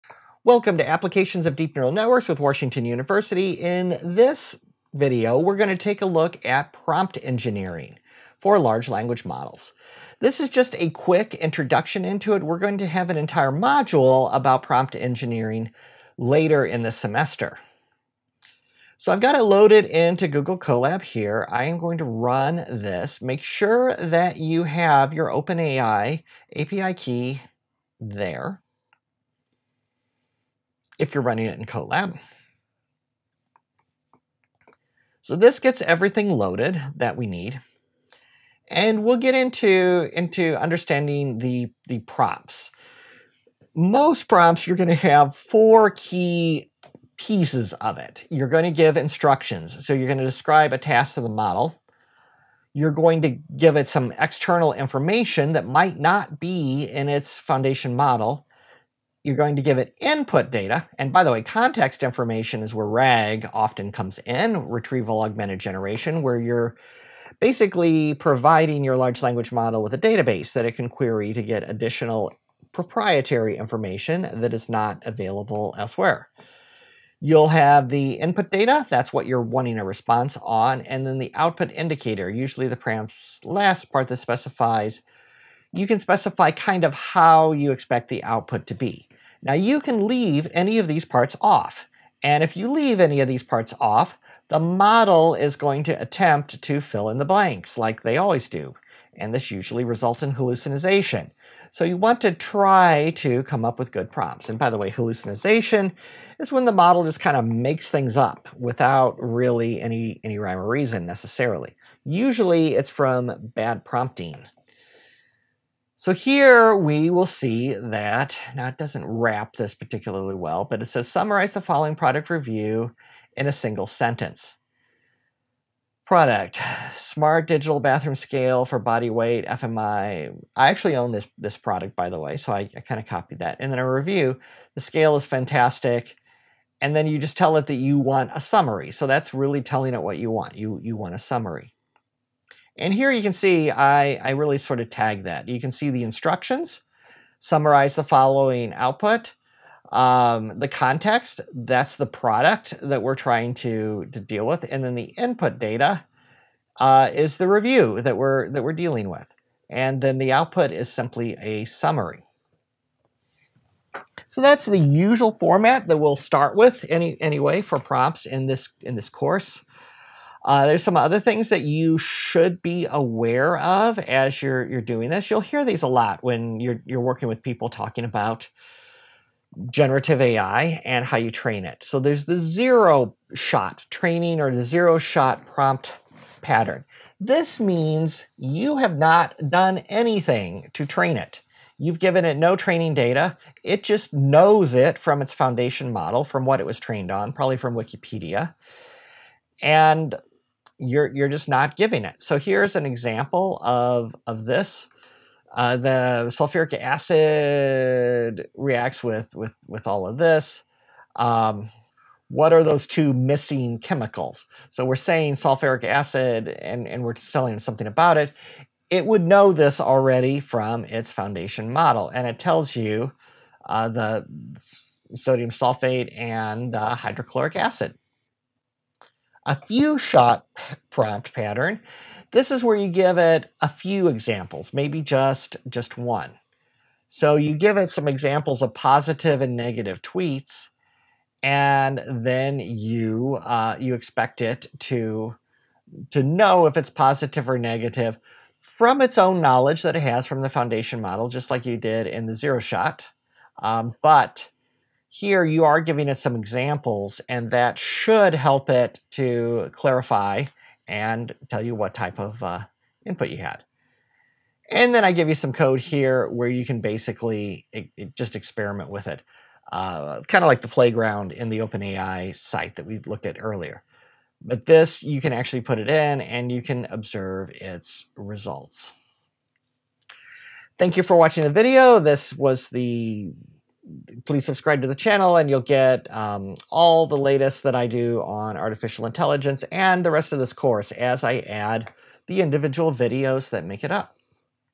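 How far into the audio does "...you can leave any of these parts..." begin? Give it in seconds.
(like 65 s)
89 s.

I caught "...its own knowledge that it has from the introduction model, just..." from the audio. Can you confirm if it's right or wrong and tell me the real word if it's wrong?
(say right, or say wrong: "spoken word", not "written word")
wrong: "foundation", not "introduction".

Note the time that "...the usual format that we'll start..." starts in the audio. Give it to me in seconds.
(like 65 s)
164 s.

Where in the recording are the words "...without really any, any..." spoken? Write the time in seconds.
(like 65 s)
108 s.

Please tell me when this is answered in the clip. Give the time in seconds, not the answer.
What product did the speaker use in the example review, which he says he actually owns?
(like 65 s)
126 s.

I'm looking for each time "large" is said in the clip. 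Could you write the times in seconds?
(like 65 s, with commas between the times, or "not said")
8 s, 68 s.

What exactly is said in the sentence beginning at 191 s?
You've given it no training data.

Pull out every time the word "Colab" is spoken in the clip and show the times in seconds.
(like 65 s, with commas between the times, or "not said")
20 s, 31 s.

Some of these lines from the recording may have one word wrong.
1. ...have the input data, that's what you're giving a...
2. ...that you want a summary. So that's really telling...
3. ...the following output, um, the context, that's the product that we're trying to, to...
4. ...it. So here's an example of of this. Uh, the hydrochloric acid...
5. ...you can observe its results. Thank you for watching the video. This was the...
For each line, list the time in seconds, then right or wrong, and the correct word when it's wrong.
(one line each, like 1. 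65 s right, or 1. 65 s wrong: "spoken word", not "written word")
1. 77 s wrong: "wanting", not "giving"
2. 137 s right
3. 147 s right
4. 202 s wrong: "sulfuric", not "hydrochloric"
5. 276 s right.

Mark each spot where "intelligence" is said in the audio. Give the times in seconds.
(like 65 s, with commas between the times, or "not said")
289 s.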